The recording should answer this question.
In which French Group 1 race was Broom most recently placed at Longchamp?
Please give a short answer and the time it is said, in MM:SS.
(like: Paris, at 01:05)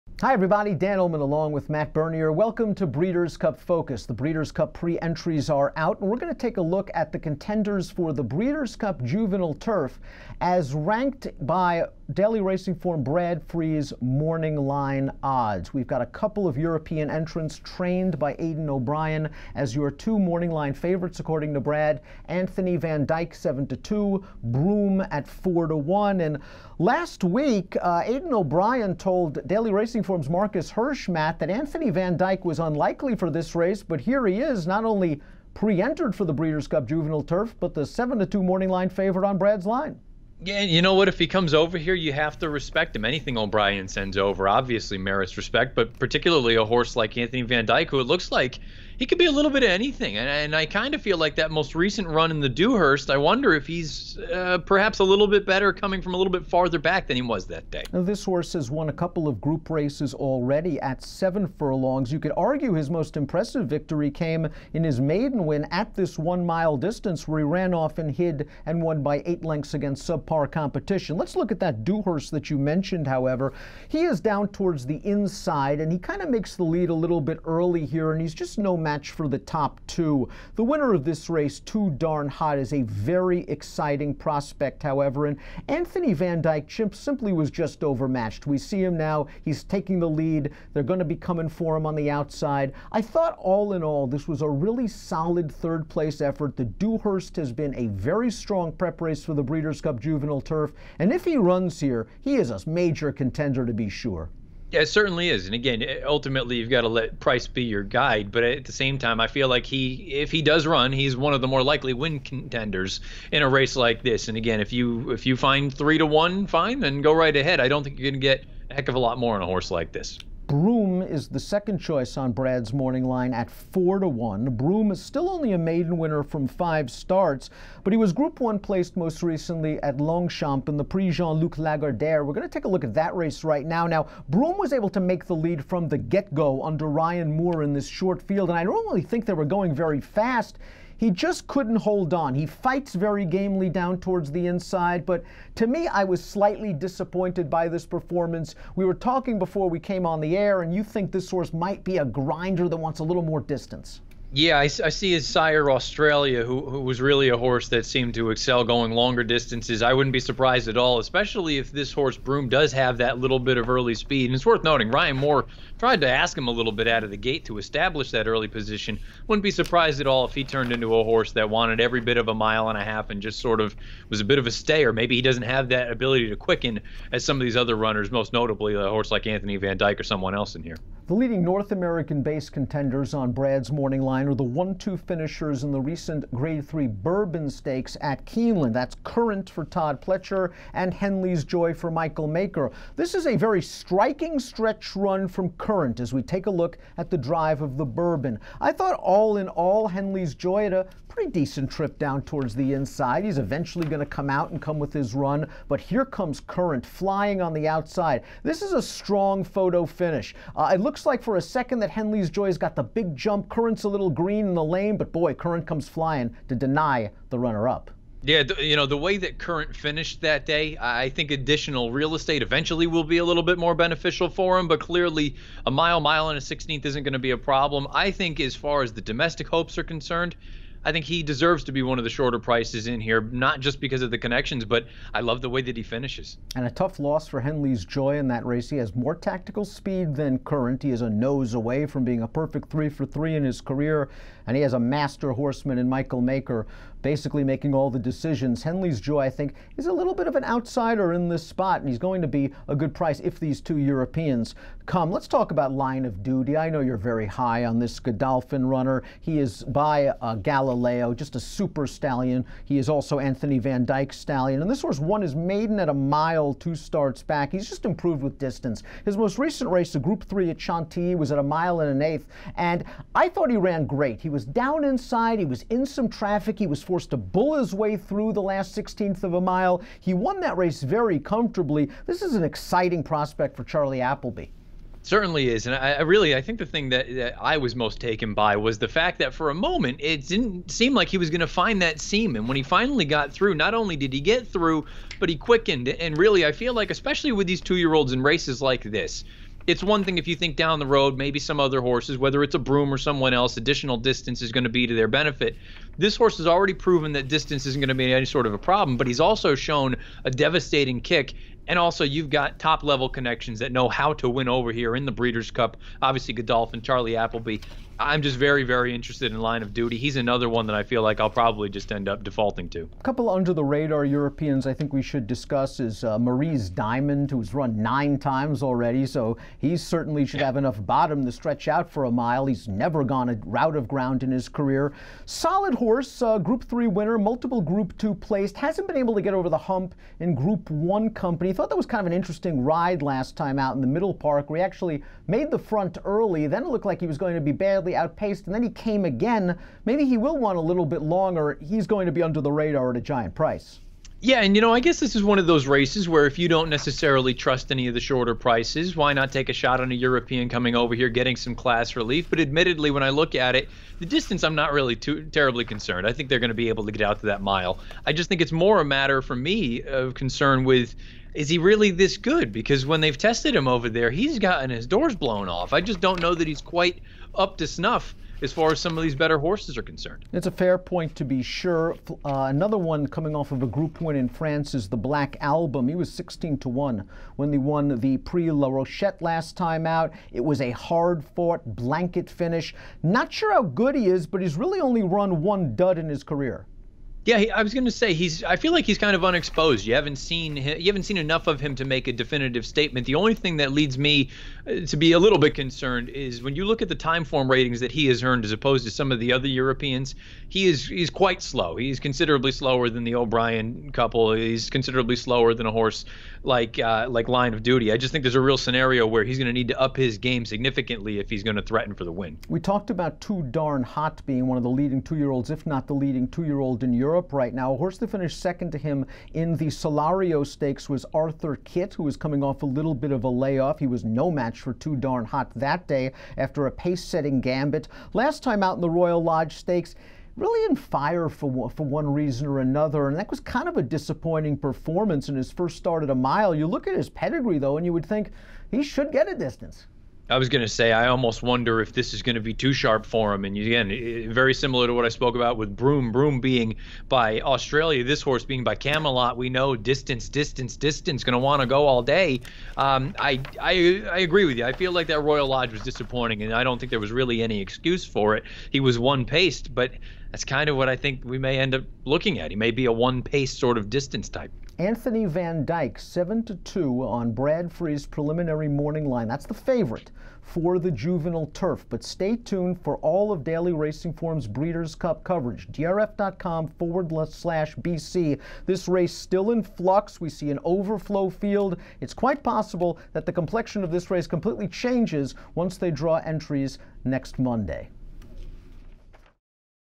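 Prix Jean Luc Lagardère, at 02:10.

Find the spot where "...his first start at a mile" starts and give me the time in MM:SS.
07:25.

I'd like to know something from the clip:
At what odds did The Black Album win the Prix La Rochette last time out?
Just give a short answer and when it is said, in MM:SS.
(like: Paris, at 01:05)
16 to 1, at 06:26.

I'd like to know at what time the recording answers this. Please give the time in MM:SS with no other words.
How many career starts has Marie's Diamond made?
05:27.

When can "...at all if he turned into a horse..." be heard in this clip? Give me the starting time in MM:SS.
02:49.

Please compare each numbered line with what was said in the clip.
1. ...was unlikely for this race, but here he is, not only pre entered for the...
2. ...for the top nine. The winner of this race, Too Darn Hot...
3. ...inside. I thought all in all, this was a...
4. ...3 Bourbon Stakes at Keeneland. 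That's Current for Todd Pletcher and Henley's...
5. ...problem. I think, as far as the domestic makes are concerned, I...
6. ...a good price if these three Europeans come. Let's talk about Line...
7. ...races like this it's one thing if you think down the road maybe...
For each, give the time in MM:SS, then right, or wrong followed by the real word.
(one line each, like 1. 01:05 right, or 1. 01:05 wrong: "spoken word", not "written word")
1. 00:32 right
2. 01:19 wrong: "two", not "nine"
3. 01:32 wrong: "outside", not "inside"
4. 03:06 right
5. 03:47 wrong: "hopes", not "makes"
6. 04:12 wrong: "two", not "three"
7. 04:58 right.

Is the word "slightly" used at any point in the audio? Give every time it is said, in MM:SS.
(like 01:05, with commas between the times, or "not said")
02:26, 05:47.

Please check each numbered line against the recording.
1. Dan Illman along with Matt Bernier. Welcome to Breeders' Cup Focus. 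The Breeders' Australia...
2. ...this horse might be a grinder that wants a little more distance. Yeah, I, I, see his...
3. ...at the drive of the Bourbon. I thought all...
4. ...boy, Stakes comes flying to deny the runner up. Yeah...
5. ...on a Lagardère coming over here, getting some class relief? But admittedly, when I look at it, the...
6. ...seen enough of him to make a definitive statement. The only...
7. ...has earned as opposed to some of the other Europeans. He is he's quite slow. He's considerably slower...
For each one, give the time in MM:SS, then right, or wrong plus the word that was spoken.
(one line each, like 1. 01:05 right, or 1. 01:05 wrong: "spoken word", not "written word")
1. 00:00 wrong: "Cup", not "Australia"
2. 02:31 right
3. 03:16 right
4. 03:35 wrong: "Current", not "Stakes"
5. 05:59 wrong: "European", not "Lagardère"
6. 06:41 right
7. 06:48 right.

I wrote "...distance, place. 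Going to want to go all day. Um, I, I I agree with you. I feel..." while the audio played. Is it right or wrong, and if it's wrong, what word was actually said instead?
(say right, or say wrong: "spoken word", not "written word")
wrong: "distance", not "place".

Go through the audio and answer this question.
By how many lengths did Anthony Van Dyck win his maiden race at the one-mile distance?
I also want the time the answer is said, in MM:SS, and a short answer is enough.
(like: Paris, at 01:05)
8, at 01:09.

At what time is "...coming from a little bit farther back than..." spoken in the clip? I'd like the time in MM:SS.
00:55.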